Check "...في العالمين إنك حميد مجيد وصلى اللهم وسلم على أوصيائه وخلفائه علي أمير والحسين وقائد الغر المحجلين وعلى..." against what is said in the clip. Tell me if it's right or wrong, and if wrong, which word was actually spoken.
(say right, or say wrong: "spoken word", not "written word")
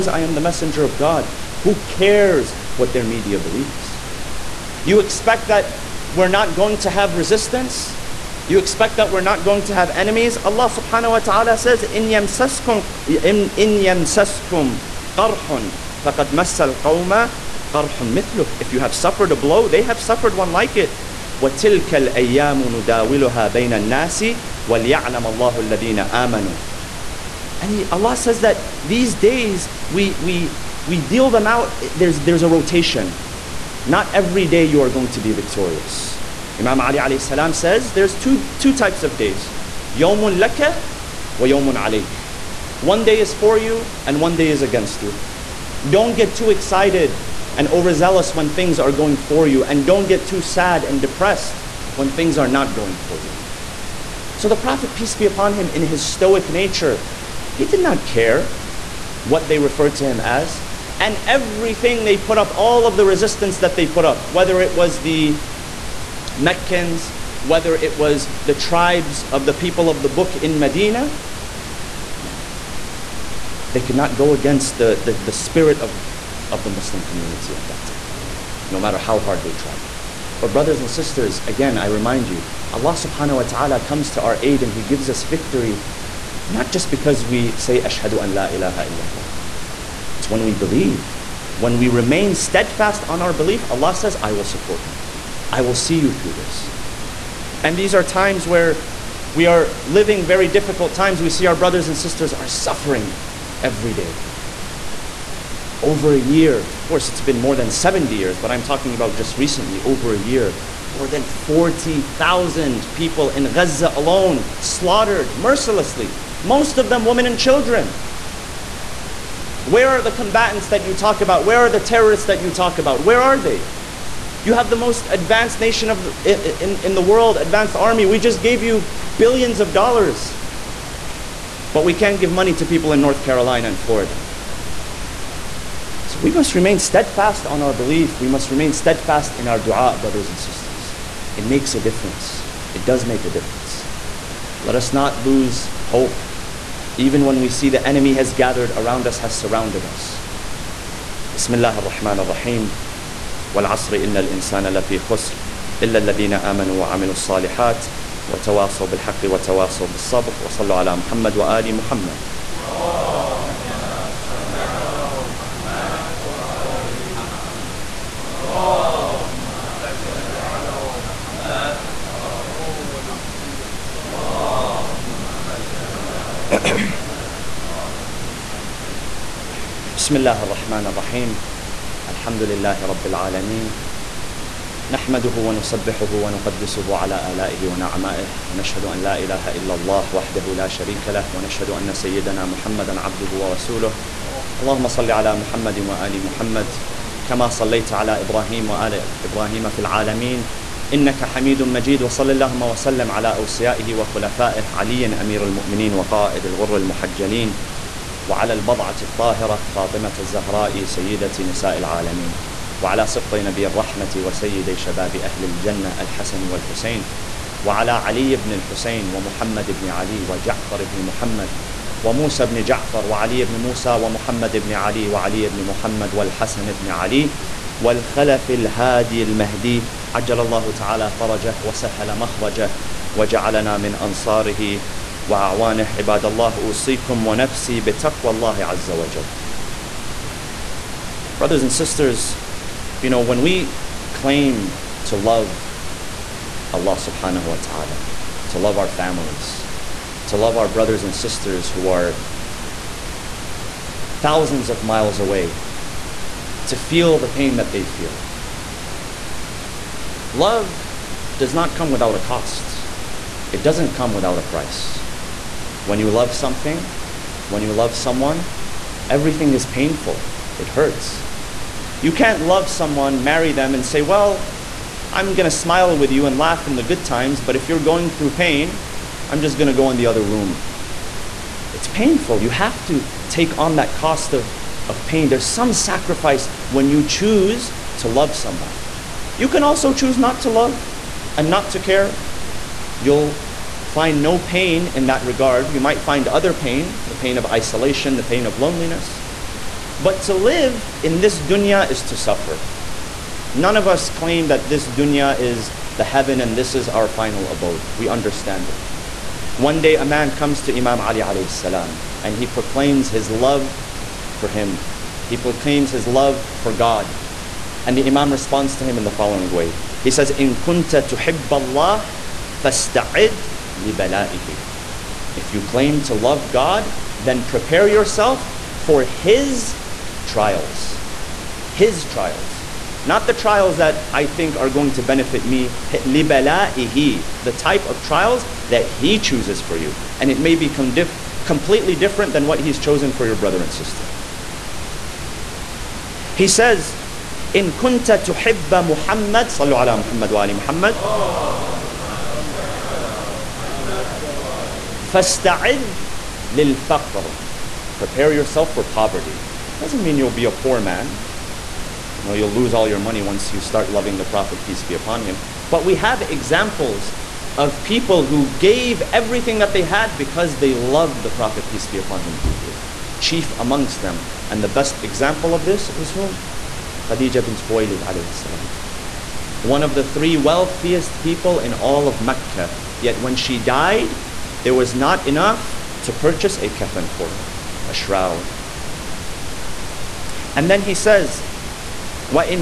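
wrong: "المؤمنين", not "والحسين".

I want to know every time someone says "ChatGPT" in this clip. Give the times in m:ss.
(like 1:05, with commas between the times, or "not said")
not said.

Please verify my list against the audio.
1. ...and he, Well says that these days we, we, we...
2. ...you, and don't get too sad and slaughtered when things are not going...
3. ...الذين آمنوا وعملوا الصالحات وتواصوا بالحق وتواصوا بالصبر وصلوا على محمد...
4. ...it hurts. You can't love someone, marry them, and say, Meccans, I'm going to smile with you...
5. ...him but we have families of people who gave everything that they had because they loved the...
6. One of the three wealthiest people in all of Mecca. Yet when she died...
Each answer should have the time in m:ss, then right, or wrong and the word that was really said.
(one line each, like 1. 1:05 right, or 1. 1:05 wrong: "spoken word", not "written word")
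1. 0:27 wrong: "Allah", not "Well"
2. 0:49 wrong: "depressed", not "slaughtered"
3. 2:35 right
4. 4:30 wrong: "Well", not "Meccans"
5. 6:05 wrong: "examples", not "families"
6. 6:19 right.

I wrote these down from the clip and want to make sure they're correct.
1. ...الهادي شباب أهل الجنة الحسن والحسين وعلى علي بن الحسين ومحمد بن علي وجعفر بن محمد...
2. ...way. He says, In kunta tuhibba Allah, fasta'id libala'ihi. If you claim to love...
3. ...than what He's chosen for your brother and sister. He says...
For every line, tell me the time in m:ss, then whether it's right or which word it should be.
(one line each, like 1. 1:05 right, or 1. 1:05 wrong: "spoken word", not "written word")
1. 3:34 wrong: "وسيدي", not "الهادي"
2. 5:19 right
3. 5:42 right.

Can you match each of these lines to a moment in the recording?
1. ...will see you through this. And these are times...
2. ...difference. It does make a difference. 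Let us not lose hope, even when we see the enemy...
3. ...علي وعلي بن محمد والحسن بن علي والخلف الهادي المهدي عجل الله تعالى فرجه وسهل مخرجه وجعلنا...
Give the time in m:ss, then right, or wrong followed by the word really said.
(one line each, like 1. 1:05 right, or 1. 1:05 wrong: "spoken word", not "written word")
1. 1:35 right
2. 2:21 right
3. 3:44 right.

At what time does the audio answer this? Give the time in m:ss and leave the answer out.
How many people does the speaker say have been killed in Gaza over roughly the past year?
1:50.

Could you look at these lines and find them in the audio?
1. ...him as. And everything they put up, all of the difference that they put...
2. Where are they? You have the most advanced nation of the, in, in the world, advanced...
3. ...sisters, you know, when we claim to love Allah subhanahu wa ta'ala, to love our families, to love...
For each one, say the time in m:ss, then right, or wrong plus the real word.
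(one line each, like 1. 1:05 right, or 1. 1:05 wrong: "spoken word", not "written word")
1. 1:00 wrong: "resistance", not "difference"
2. 2:03 right
3. 4:01 right.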